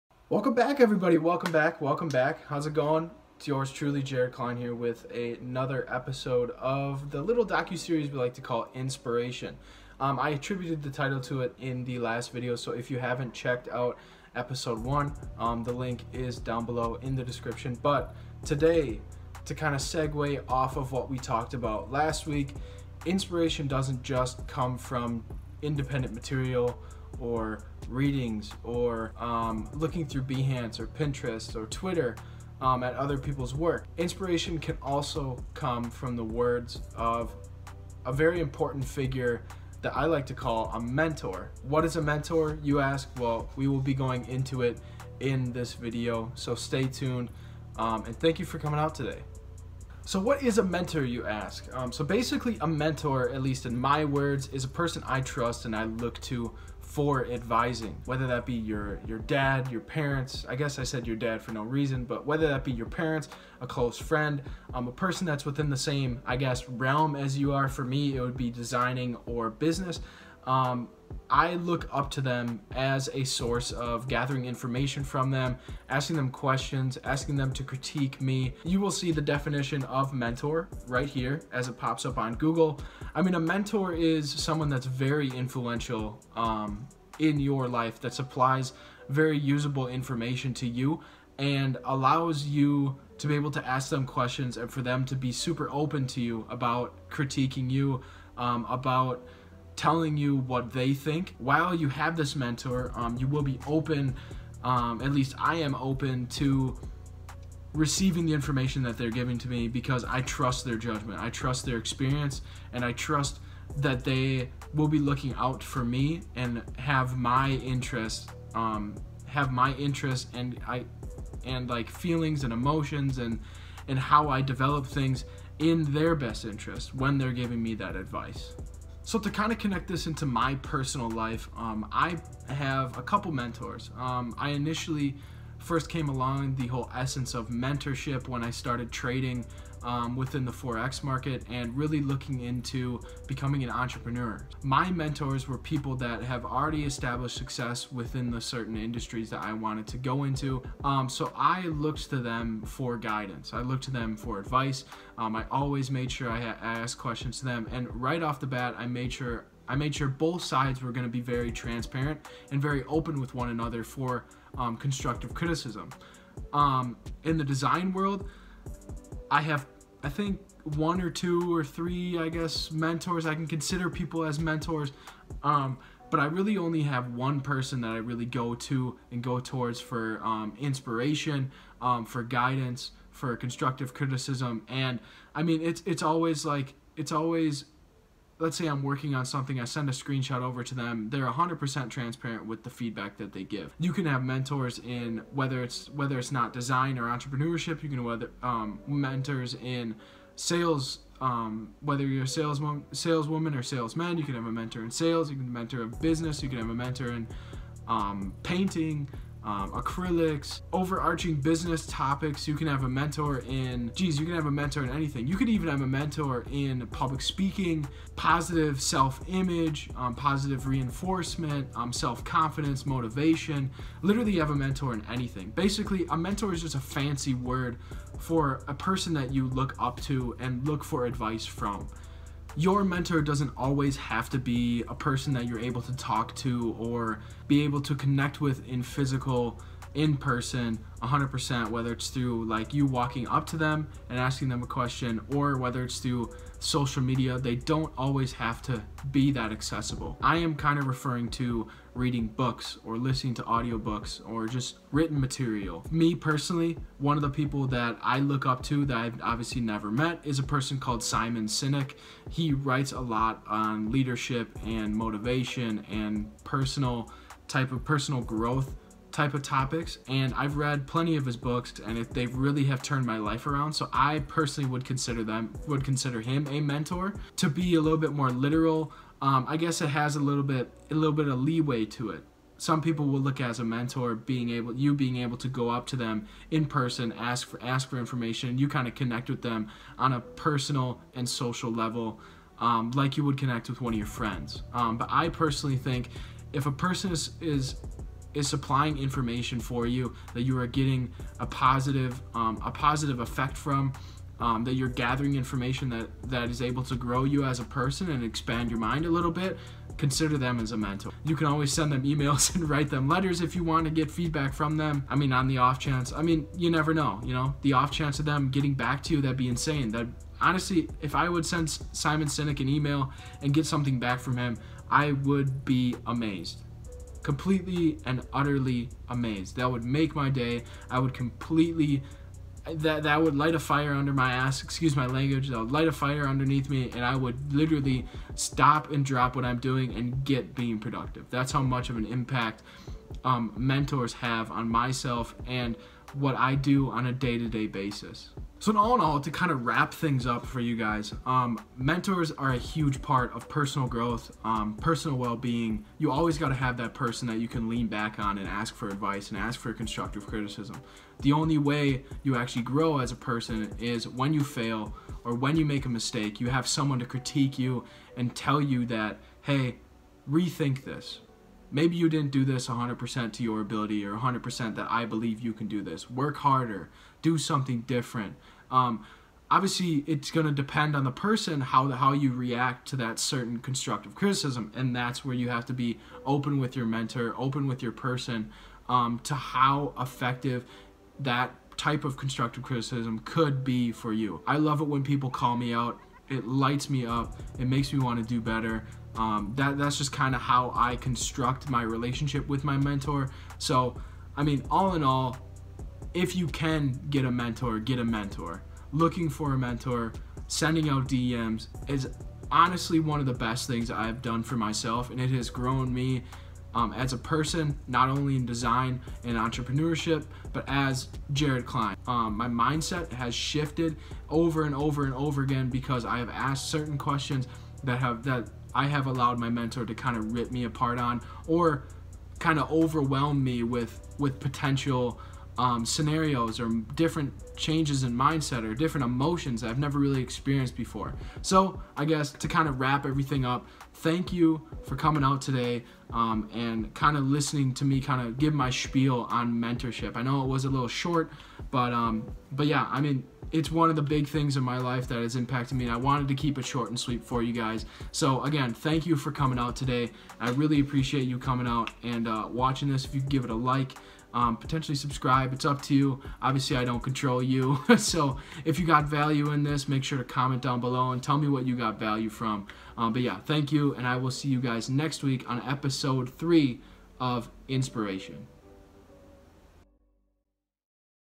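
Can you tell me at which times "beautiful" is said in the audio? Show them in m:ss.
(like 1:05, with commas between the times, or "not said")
not said.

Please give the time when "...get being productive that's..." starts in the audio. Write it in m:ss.
5:40.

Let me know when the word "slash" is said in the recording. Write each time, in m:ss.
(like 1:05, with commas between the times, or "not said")
not said.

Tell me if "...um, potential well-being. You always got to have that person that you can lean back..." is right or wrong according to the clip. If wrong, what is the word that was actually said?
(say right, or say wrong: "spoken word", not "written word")
wrong: "personal", not "potential".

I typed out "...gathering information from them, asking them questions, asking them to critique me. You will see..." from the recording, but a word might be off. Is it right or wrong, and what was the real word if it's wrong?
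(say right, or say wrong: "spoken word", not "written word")
right.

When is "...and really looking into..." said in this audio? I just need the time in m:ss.
2:21.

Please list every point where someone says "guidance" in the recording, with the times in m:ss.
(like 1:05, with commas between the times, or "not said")
2:32, 3:02.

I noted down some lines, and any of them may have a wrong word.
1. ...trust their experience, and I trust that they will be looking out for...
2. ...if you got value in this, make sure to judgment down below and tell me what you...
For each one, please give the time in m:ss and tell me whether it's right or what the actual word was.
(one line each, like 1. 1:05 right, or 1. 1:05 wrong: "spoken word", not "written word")
1. 1:51 right
2. 7:48 wrong: "comment", not "judgment".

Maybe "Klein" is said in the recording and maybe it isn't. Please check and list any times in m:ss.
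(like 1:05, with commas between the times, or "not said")
0:04, 7:01.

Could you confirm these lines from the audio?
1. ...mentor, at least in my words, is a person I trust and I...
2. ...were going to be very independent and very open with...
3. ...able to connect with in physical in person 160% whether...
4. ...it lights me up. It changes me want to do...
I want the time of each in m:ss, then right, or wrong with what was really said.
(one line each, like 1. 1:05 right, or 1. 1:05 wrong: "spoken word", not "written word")
1. 0:52 right
2. 2:40 wrong: "transparent", not "independent"
3. 3:57 wrong: "100", not "160"
4. 6:36 wrong: "makes", not "changes".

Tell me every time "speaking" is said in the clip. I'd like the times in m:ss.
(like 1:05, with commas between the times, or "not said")
3:37.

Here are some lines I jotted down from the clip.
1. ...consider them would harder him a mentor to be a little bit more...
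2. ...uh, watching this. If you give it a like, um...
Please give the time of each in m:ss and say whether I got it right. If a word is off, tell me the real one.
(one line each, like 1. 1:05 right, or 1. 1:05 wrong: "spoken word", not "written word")
1. 4:34 wrong: "consider", not "harder"
2. 7:42 right.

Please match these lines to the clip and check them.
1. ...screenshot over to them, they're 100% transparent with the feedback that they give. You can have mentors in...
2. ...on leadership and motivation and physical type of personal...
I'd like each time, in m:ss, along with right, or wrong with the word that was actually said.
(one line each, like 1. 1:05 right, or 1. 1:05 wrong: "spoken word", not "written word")
1. 3:09 right
2. 4:23 wrong: "personal", not "physical".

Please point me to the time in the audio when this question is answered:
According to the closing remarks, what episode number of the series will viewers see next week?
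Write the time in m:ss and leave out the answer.
7:55.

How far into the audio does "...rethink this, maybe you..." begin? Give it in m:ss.
6:10.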